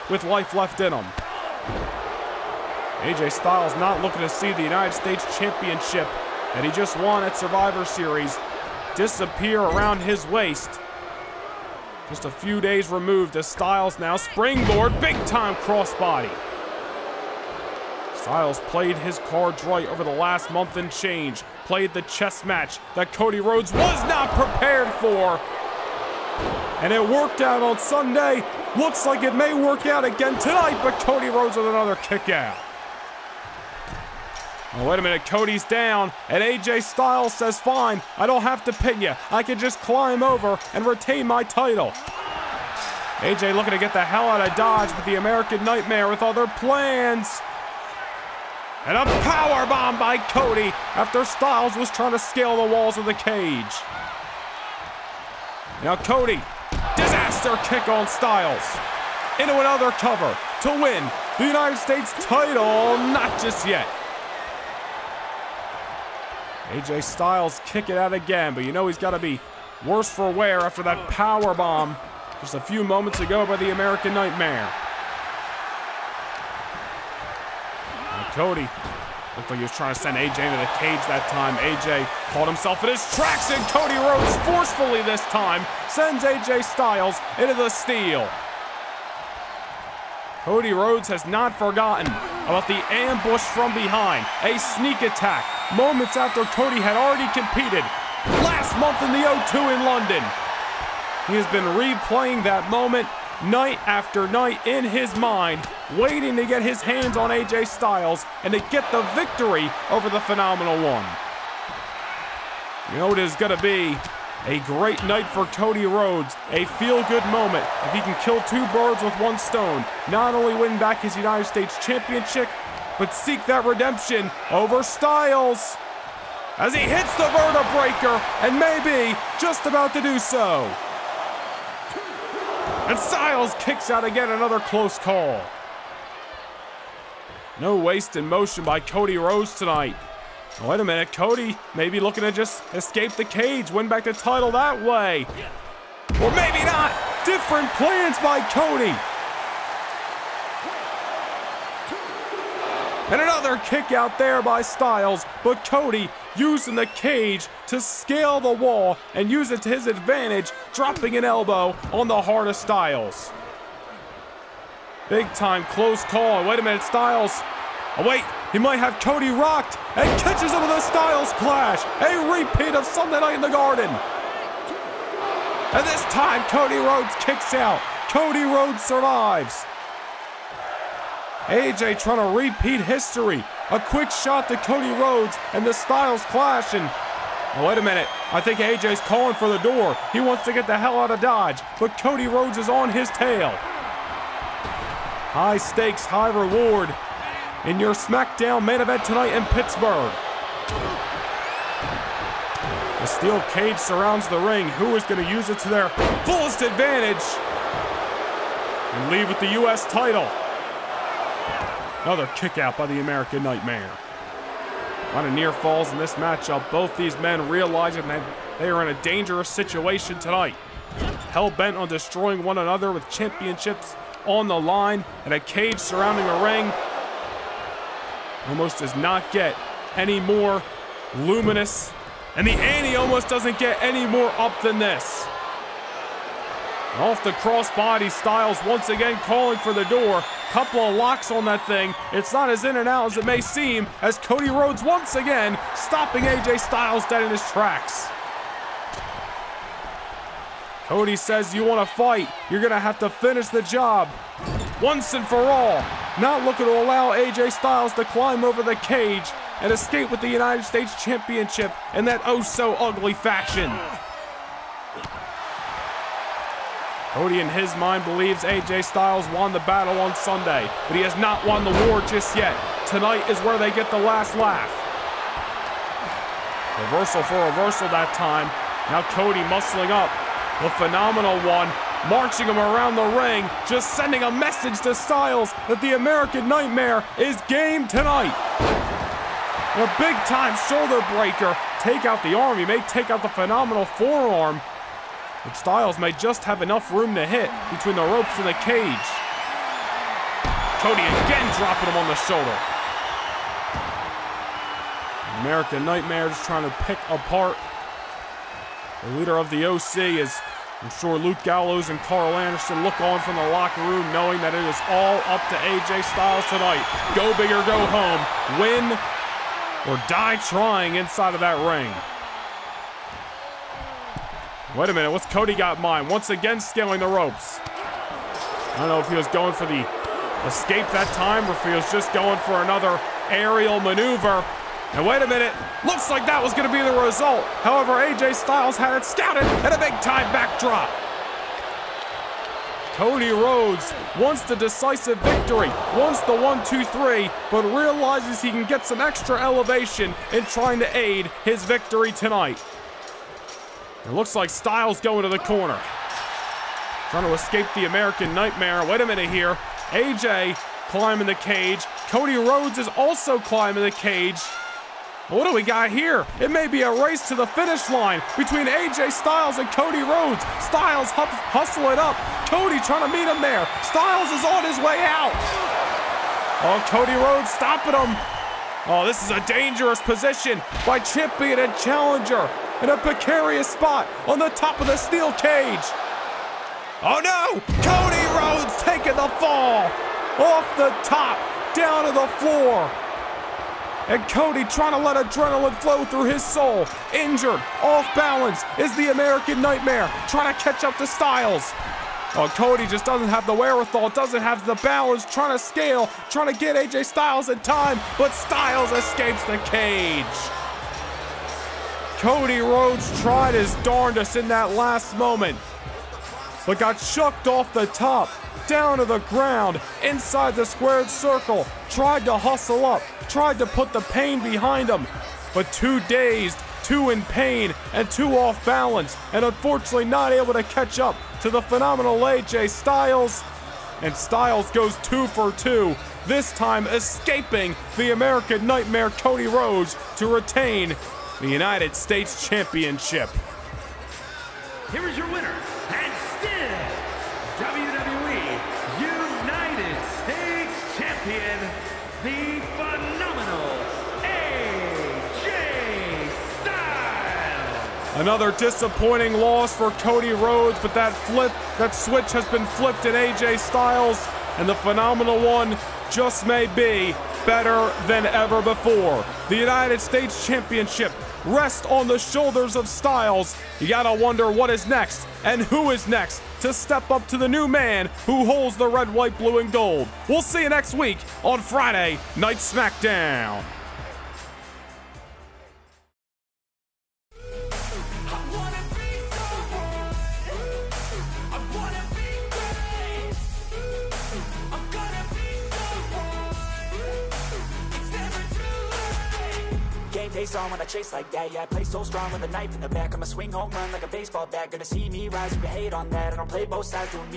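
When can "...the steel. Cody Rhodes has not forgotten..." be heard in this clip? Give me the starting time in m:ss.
1:27.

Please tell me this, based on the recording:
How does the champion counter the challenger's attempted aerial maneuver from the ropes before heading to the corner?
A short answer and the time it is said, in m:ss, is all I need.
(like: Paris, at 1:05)
Backdrop, at 5:40.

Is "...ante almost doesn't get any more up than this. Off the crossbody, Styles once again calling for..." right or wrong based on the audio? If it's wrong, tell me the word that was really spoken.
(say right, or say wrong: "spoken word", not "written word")
right.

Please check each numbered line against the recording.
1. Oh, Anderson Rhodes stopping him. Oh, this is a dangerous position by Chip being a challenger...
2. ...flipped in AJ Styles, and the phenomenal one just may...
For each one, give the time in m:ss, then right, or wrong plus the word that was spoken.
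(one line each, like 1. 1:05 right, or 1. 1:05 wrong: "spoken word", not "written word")
1. 6:16 wrong: "Cody", not "Anderson"
2. 7:42 right.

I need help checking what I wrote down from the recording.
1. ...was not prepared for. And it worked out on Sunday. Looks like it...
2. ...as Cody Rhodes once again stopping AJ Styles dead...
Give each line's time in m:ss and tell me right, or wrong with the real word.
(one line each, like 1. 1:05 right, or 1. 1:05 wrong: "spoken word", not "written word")
1. 0:23 right
2. 4:04 right.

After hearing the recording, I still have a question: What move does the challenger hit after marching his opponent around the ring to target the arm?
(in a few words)
Shoulder breaker.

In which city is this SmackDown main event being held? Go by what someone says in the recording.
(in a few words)
Pittsburgh.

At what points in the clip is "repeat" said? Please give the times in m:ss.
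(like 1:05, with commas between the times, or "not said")
2:52, 3:02.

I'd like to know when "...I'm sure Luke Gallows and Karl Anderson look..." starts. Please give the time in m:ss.
5:10.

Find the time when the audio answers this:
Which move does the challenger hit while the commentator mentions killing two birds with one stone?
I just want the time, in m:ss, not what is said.
2:07.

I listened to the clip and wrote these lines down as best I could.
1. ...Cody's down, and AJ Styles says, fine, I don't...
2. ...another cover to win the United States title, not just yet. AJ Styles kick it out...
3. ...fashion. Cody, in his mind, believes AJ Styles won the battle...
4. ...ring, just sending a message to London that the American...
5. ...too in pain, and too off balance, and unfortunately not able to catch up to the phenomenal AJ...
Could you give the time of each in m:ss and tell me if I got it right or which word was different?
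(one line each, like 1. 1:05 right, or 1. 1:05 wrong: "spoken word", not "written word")
1. 0:35 right
2. 0:59 right
3. 4:23 right
4. 4:43 wrong: "Styles", not "London"
5. 7:06 right.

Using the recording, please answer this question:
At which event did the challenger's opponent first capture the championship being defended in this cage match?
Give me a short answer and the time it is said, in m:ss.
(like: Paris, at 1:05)
Survivor Series, at 0:07.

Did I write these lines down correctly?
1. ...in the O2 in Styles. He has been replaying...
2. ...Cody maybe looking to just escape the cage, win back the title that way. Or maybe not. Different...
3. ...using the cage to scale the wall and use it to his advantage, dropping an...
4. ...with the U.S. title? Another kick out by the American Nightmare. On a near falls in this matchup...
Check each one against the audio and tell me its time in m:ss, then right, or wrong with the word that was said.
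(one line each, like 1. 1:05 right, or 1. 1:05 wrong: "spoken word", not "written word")
1. 1:39 wrong: "London", not "Styles"
2. 2:21 right
3. 2:36 right
4. 3:29 right.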